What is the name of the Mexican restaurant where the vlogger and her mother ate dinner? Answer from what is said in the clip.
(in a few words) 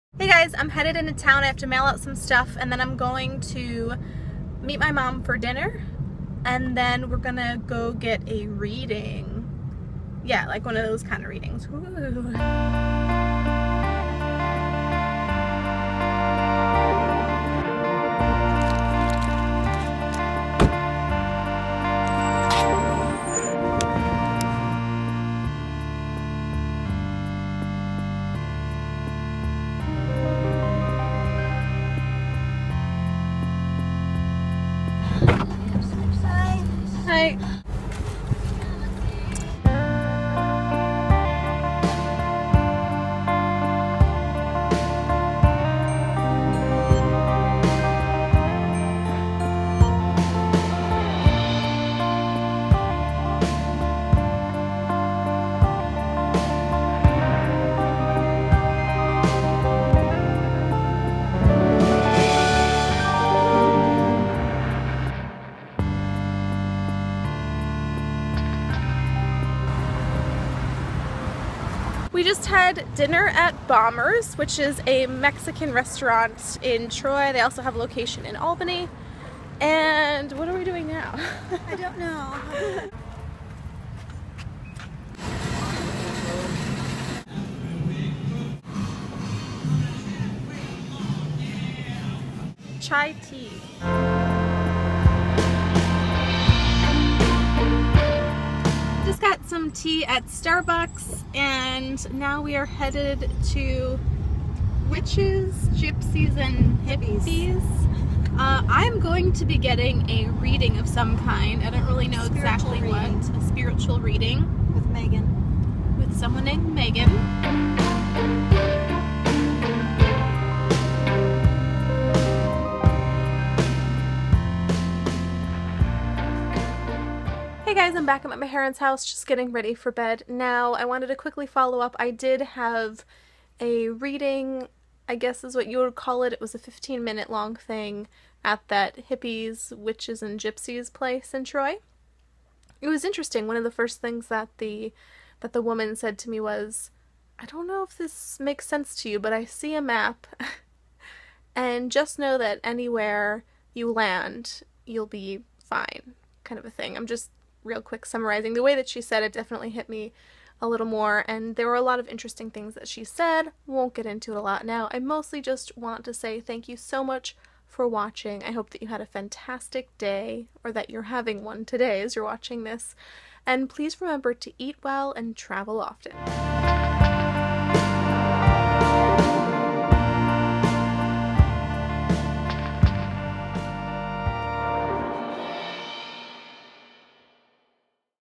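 Bombers.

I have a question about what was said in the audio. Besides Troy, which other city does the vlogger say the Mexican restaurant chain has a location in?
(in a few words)
Albany.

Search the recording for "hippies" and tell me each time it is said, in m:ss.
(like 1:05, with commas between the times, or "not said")
1:46, 2:19.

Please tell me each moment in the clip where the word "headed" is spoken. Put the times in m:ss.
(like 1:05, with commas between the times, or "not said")
0:00, 1:42.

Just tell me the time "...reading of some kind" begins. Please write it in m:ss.
1:50.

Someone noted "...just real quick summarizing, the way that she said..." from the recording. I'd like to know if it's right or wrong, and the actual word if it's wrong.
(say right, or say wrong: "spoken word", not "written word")
right.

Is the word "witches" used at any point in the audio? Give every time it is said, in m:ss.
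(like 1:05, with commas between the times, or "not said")
1:44, 2:19.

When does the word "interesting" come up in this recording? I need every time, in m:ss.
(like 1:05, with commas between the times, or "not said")
2:23, 2:42.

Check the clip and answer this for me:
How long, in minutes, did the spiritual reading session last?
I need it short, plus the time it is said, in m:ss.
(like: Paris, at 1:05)
15, at 2:16.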